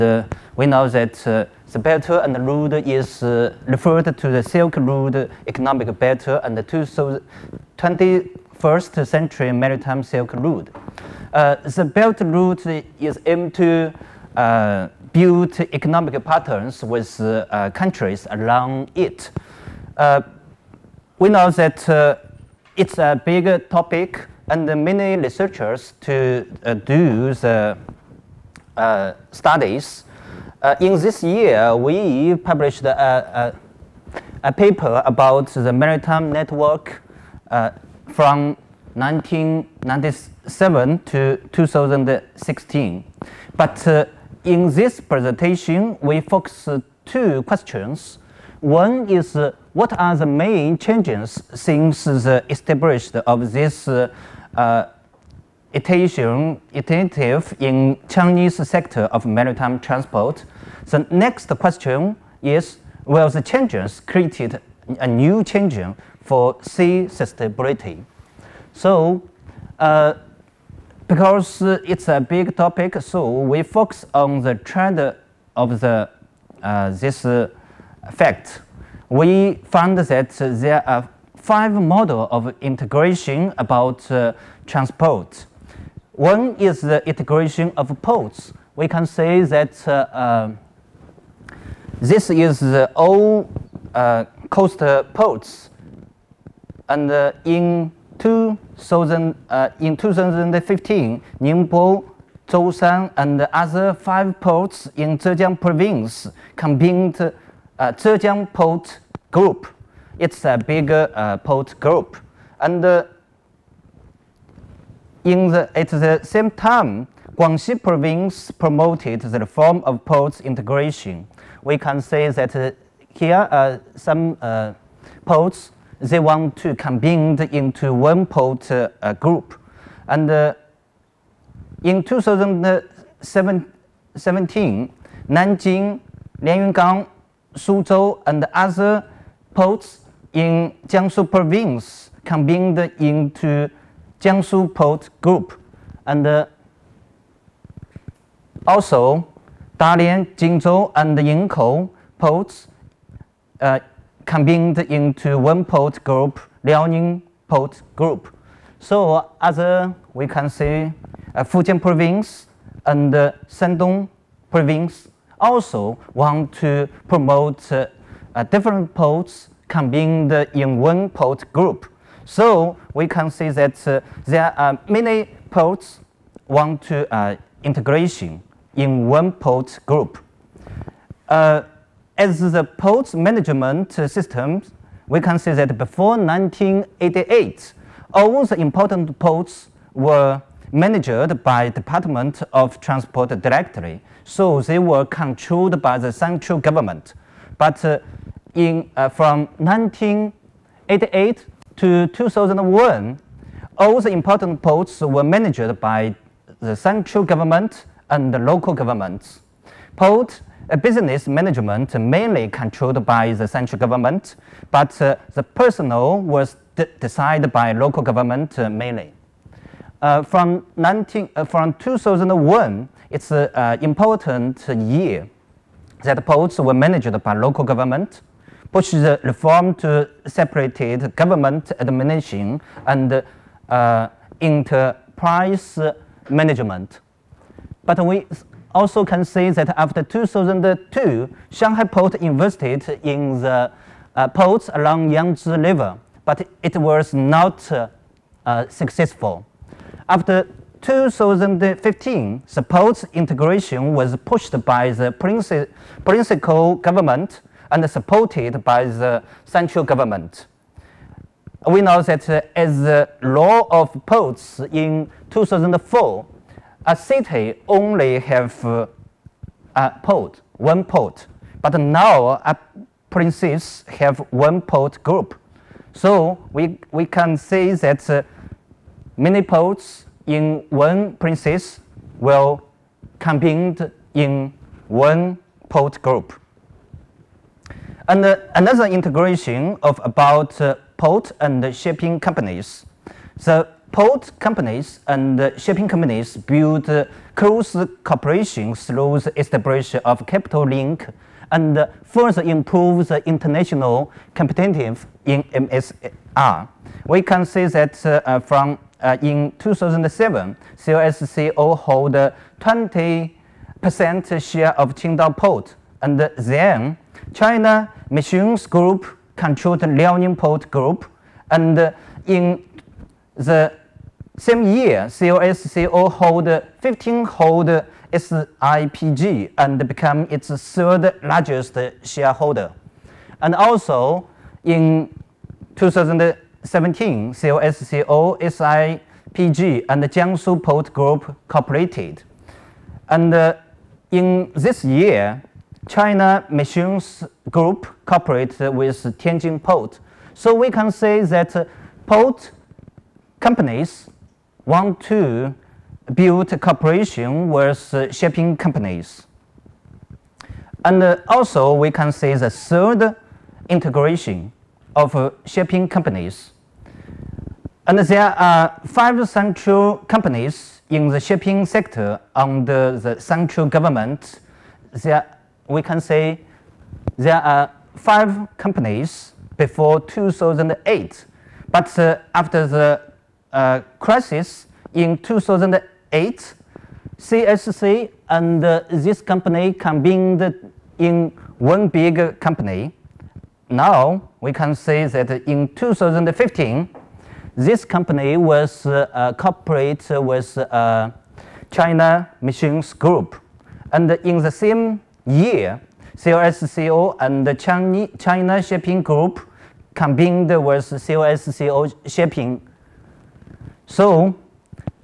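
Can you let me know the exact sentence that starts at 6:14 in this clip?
There we can say there are five companies before 2008.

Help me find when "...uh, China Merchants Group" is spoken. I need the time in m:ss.
6:40.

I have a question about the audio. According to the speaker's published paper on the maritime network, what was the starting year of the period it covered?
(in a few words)
1997.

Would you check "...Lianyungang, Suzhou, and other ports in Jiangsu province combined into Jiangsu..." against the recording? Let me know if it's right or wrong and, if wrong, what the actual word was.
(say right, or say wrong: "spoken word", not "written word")
right.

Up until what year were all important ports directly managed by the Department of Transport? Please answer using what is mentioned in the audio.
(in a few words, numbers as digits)
1988.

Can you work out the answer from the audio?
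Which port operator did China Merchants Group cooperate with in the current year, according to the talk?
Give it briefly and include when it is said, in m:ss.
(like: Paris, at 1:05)
Tianjin Port, at 5:49.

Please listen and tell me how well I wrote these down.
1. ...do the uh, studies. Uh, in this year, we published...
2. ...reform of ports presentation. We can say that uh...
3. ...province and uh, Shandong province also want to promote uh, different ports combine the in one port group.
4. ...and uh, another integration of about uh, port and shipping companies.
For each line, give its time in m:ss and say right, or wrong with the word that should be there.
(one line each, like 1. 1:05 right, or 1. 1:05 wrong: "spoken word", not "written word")
1. 0:26 right
2. 1:59 wrong: "integration", not "presentation"
3. 2:41 right
4. 4:48 right.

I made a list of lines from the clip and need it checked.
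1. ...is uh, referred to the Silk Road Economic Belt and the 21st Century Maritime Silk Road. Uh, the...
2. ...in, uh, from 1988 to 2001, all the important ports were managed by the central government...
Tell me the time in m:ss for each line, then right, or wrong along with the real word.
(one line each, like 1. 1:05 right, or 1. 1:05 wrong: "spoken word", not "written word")
1. 0:02 right
2. 3:18 right.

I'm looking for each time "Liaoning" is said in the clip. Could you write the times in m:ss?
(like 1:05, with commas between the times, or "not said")
2:36, 5:19.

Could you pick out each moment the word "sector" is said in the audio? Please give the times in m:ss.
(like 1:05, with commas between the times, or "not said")
0:58, 6:11.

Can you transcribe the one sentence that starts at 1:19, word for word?
We found that there are five models of integration about uh, transport.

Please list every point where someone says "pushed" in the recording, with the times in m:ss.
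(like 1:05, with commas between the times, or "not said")
3:48, 4:14.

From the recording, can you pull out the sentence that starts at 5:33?
And also in 2017, COSCO, SIPG, and Jiangsu Port Group cooperated.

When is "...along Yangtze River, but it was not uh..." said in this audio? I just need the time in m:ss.
4:04.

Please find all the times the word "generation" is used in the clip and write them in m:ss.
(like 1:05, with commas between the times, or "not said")
not said.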